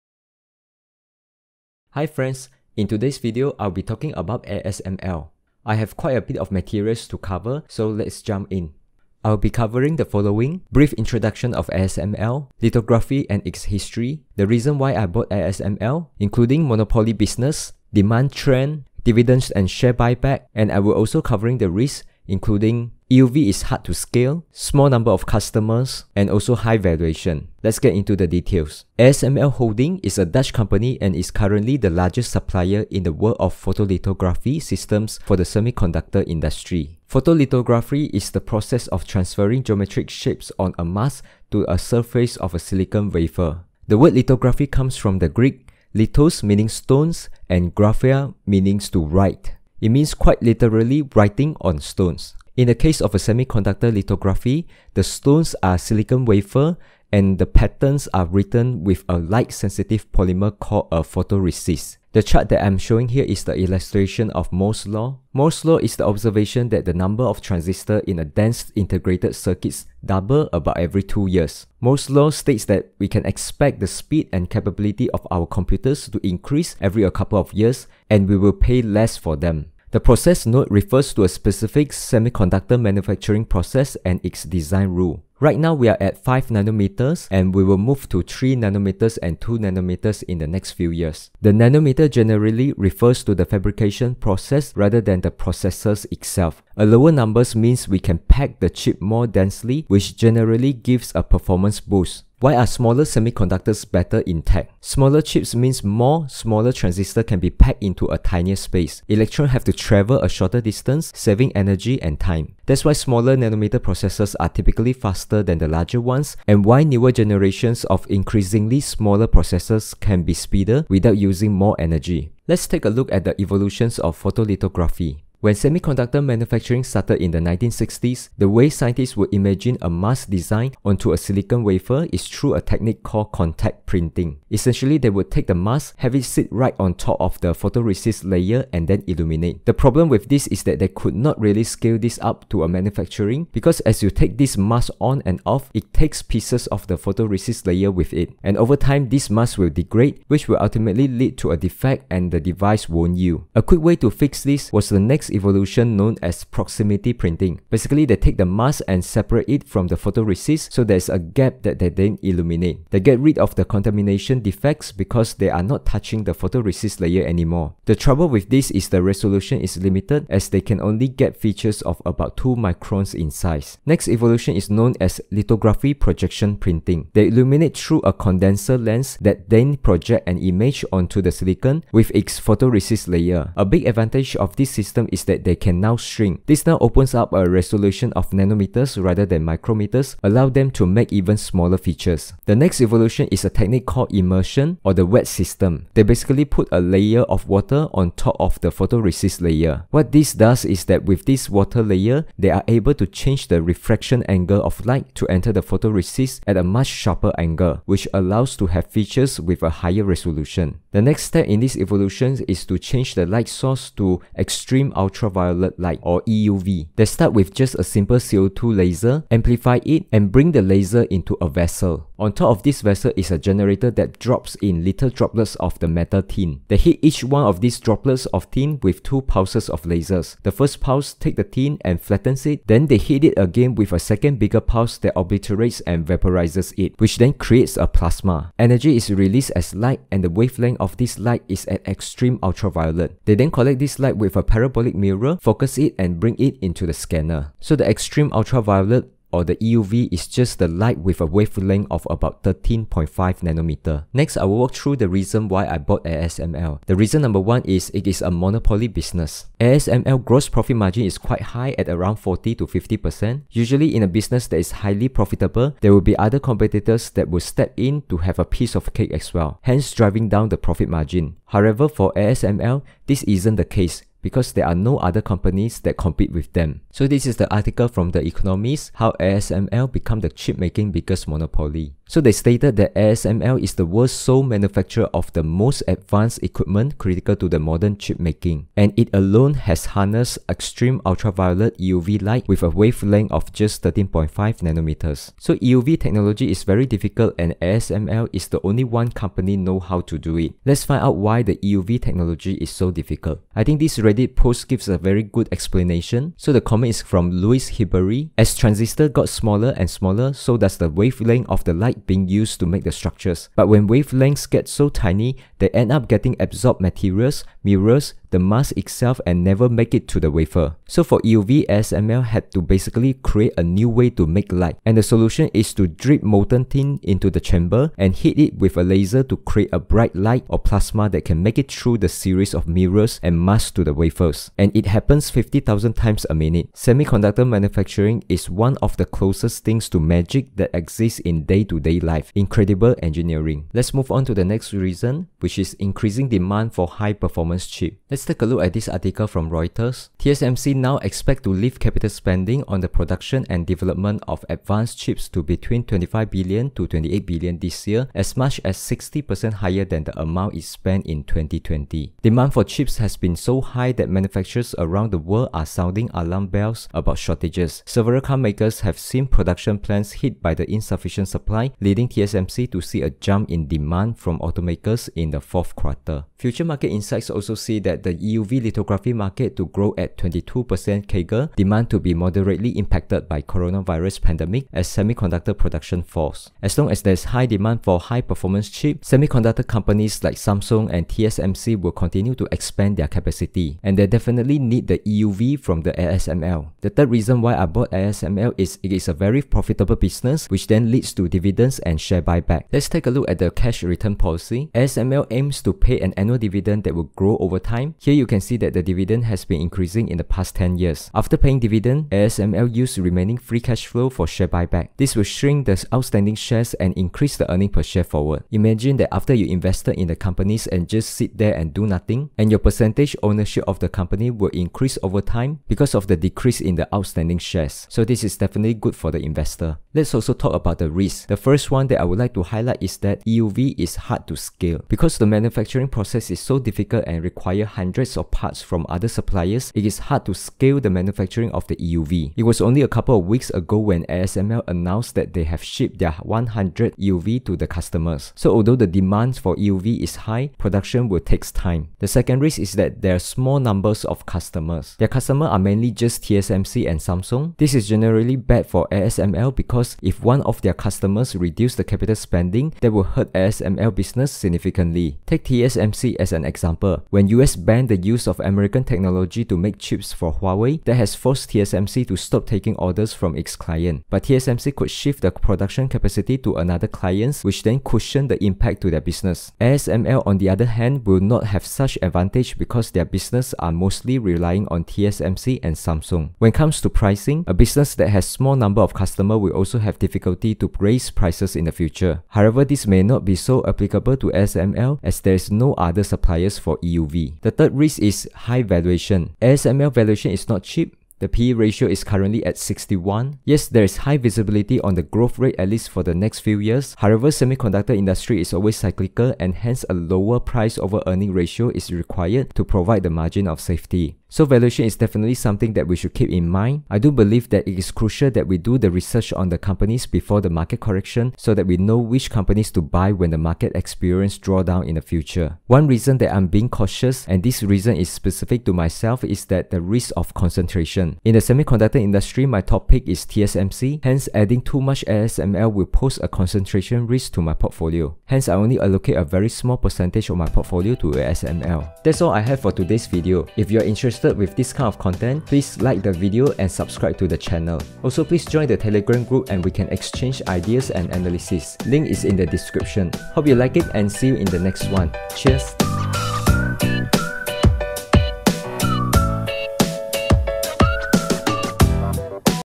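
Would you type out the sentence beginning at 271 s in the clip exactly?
However, for ASML, this isn't the case because there are no other companies that compete with them.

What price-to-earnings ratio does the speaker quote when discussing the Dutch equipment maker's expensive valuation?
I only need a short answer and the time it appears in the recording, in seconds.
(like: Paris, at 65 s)
61, at 502 s.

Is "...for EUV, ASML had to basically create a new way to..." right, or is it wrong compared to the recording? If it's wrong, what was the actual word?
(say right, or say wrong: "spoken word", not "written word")
right.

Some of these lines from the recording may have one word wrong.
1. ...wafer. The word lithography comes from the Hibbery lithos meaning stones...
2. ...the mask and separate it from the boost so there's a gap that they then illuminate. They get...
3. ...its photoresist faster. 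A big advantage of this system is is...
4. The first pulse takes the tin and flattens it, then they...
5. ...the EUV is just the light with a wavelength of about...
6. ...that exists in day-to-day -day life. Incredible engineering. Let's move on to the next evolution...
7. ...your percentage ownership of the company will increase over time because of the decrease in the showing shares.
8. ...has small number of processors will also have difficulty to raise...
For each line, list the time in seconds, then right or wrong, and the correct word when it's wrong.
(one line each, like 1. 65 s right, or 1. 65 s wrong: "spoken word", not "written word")
1. 43 s wrong: "Greek", not "Hibbery"
2. 158 s wrong: "photoresist", not "boost"
3. 182 s wrong: "layer", not "faster"
4. 230 s right
5. 249 s right
6. 340 s wrong: "reason", not "evolution"
7. 422 s wrong: "outstanding", not "showing"
8. 488 s wrong: "customers", not "processors".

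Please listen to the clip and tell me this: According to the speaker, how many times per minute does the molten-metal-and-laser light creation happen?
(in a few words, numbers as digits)
50,000.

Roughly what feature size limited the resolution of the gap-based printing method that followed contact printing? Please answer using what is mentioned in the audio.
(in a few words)
2 microns.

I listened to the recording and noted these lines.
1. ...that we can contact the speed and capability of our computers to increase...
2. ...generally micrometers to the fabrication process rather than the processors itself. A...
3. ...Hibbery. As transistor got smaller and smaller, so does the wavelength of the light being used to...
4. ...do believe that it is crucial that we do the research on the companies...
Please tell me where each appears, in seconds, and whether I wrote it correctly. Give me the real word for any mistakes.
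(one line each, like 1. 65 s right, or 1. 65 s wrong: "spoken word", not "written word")
1. 72 s wrong: "expect", not "contact"
2. 92 s wrong: "refers", not "micrometers"
3. 307 s right
4. 516 s right.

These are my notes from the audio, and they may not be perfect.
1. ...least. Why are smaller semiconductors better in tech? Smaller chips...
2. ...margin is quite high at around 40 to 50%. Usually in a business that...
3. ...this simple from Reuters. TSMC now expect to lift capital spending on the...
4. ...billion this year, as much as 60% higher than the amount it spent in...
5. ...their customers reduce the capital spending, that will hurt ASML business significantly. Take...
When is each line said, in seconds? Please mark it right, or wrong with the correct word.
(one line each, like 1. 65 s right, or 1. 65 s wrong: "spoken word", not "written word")
1. 101 s wrong: "boost", not "least"
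2. 260 s right
3. 348 s wrong: "article", not "simple"
4. 357 s right
5. 460 s right.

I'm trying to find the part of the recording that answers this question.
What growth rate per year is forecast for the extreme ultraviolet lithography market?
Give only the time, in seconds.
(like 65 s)
380 s.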